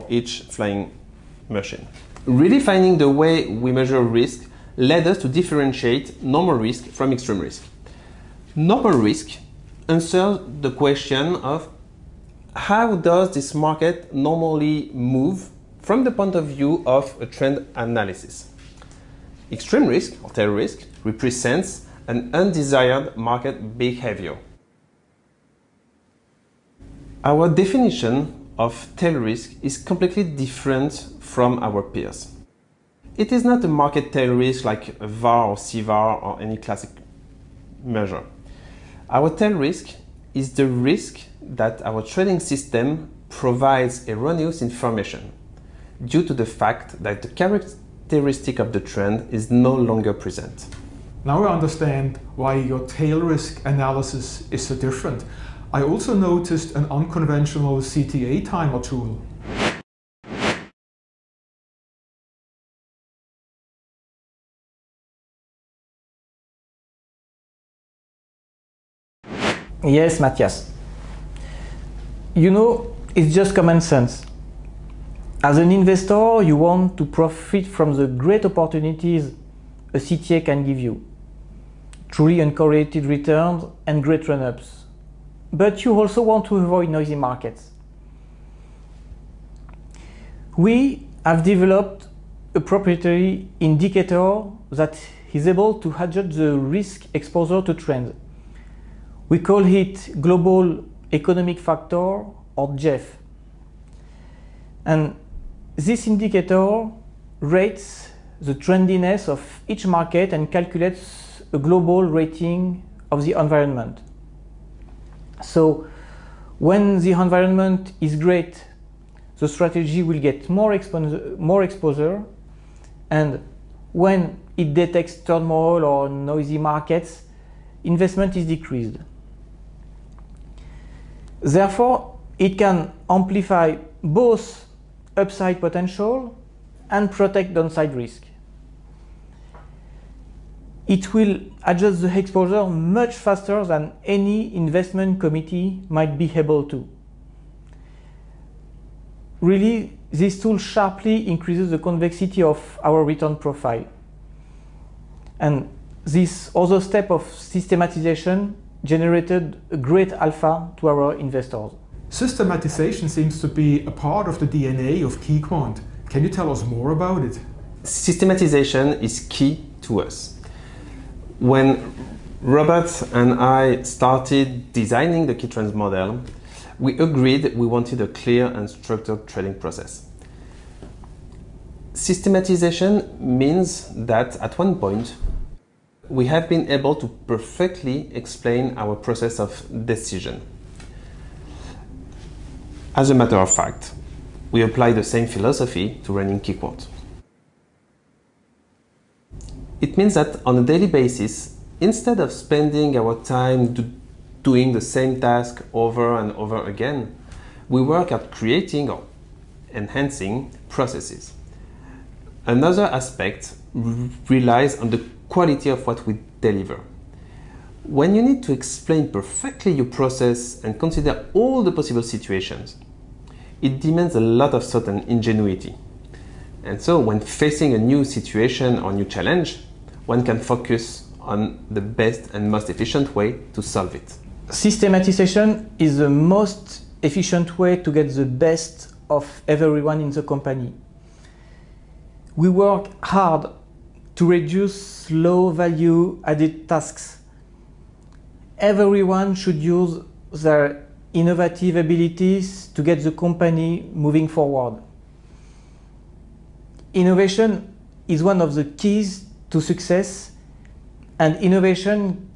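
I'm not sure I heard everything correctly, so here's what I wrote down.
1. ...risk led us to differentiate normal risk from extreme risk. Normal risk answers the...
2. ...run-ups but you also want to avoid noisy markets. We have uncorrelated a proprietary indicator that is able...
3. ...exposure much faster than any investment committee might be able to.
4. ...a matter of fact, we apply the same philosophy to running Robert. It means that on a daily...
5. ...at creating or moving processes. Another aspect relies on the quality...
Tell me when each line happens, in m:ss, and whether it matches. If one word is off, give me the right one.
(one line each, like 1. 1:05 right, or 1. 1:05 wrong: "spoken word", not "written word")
1. 0:04 right
2. 1:24 wrong: "developed", not "uncorrelated"
3. 2:22 right
4. 3:13 wrong: "KeyQuant", not "Robert"
5. 3:28 wrong: "enhancing", not "moving".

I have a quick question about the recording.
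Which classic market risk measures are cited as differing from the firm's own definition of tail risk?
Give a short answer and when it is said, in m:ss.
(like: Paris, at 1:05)
VAR or CVAR, at 0:34.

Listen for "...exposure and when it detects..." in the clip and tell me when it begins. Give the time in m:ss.
2:01.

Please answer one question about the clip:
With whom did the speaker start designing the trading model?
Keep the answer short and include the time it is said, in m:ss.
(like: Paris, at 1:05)
Robert, at 2:52.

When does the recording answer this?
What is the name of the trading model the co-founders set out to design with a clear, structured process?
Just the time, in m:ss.
2:55.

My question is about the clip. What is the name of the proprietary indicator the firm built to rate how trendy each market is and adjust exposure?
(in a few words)
Global Economic Factor.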